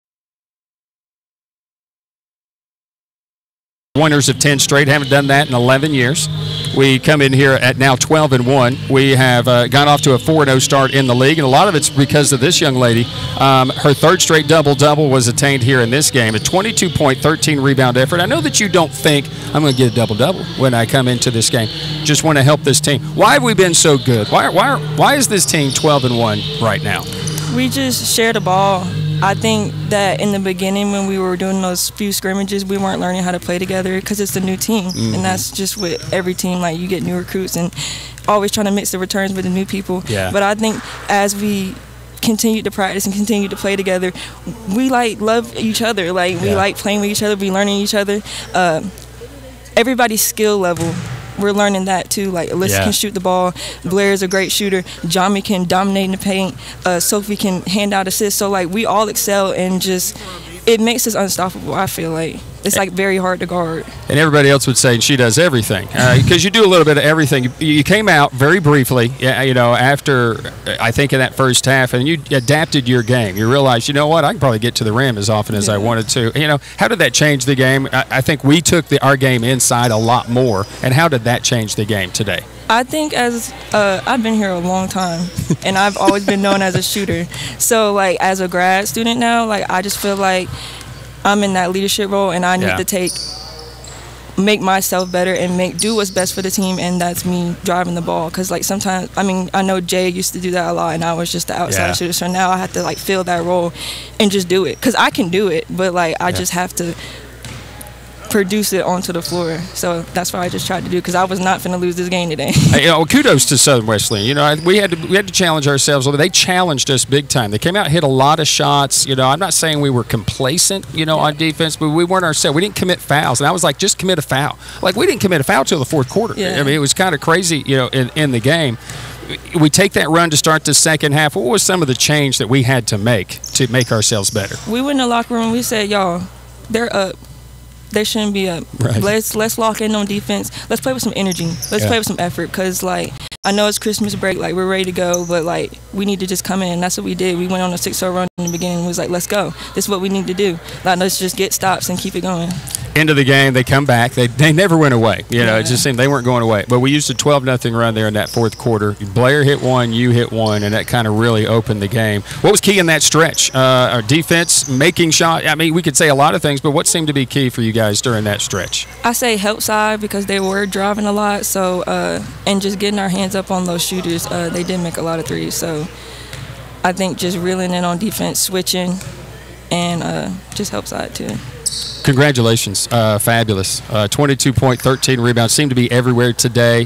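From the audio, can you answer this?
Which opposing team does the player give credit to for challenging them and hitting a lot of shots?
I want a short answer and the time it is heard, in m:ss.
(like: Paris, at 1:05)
Southern Wesleyan, at 1:53.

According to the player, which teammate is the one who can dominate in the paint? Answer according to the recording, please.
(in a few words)
Jami.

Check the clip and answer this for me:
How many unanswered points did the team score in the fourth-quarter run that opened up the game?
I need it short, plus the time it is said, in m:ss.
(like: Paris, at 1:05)
12, at 2:37.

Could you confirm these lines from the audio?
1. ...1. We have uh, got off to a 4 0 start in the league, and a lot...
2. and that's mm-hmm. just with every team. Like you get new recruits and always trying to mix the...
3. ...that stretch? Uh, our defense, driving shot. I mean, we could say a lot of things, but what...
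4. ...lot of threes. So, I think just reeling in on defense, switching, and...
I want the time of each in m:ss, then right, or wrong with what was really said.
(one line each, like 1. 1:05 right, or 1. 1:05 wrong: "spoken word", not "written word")
1. 0:08 right
2. 0:35 right
3. 2:42 wrong: "making", not "driving"
4. 2:55 right.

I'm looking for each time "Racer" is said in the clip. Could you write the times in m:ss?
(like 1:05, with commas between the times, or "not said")
not said.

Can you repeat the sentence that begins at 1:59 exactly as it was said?
You know, I'm not saying we were complacent.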